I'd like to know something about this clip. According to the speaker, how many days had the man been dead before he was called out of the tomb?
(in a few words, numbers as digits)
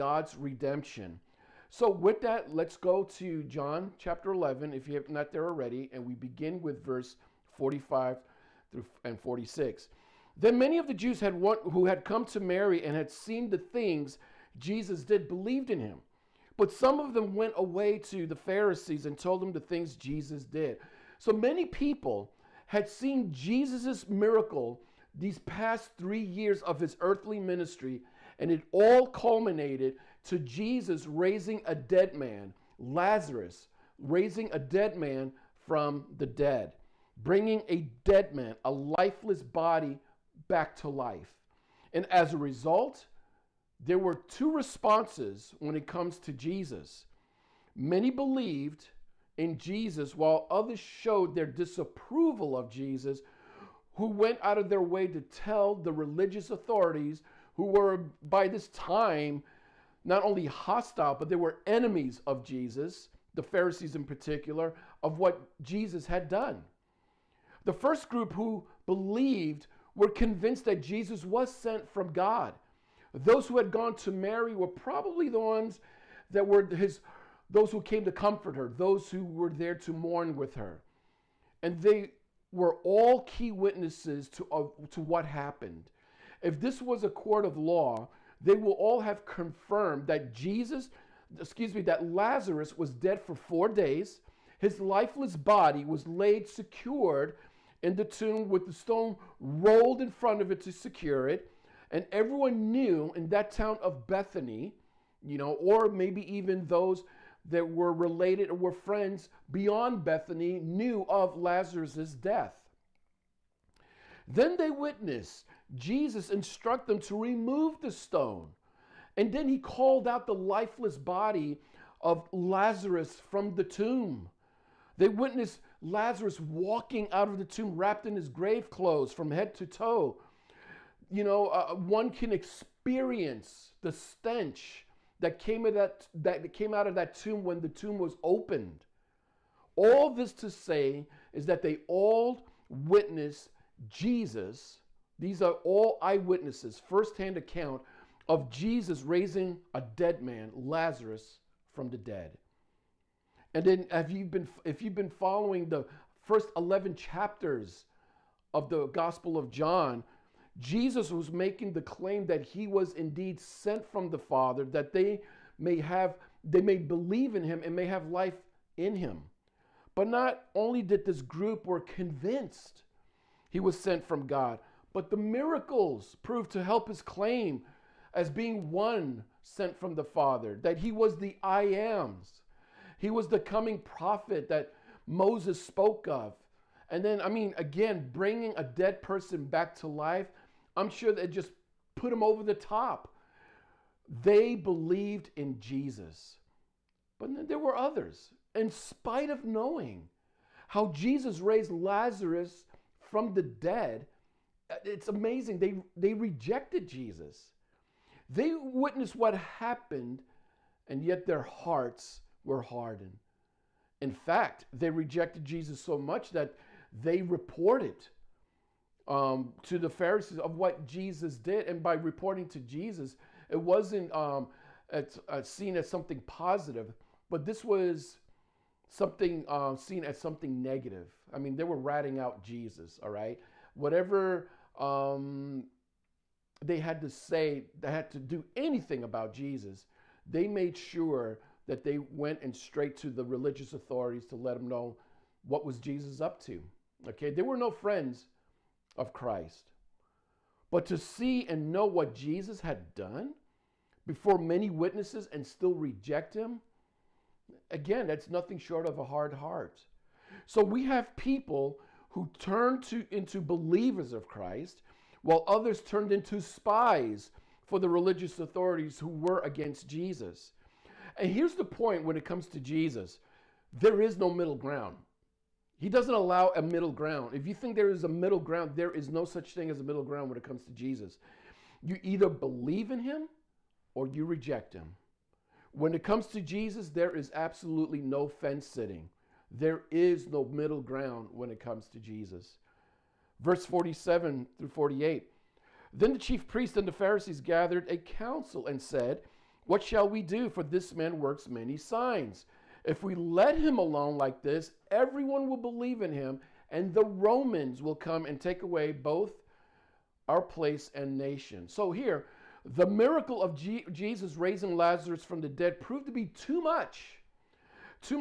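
4.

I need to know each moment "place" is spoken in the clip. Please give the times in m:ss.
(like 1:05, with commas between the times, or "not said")
5:10.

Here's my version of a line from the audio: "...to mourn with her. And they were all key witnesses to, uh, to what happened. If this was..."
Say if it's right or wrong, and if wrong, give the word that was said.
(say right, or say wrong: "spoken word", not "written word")
right.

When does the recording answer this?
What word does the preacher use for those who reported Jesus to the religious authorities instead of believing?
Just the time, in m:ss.
4:26.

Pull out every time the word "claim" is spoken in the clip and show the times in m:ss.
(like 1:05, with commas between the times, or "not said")
2:41, 2:57.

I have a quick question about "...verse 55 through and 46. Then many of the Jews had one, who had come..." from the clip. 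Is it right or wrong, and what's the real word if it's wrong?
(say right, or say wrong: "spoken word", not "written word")
wrong: "45", not "55".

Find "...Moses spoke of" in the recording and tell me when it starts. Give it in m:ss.
3:05.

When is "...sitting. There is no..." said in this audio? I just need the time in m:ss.
4:48.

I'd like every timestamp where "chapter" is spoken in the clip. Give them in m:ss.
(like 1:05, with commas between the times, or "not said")
0:03, 2:36.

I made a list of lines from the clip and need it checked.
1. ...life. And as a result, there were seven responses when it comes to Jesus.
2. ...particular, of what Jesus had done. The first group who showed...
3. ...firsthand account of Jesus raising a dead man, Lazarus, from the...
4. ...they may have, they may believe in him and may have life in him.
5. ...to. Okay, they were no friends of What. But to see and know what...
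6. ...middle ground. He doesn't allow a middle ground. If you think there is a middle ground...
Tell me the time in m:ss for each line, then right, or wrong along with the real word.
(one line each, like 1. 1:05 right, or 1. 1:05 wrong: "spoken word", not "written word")
1. 0:40 wrong: "two", not "seven"
2. 1:04 wrong: "believed", not "showed"
3. 2:26 right
4. 2:44 right
5. 4:06 wrong: "Christ", not "What"
6. 4:34 right.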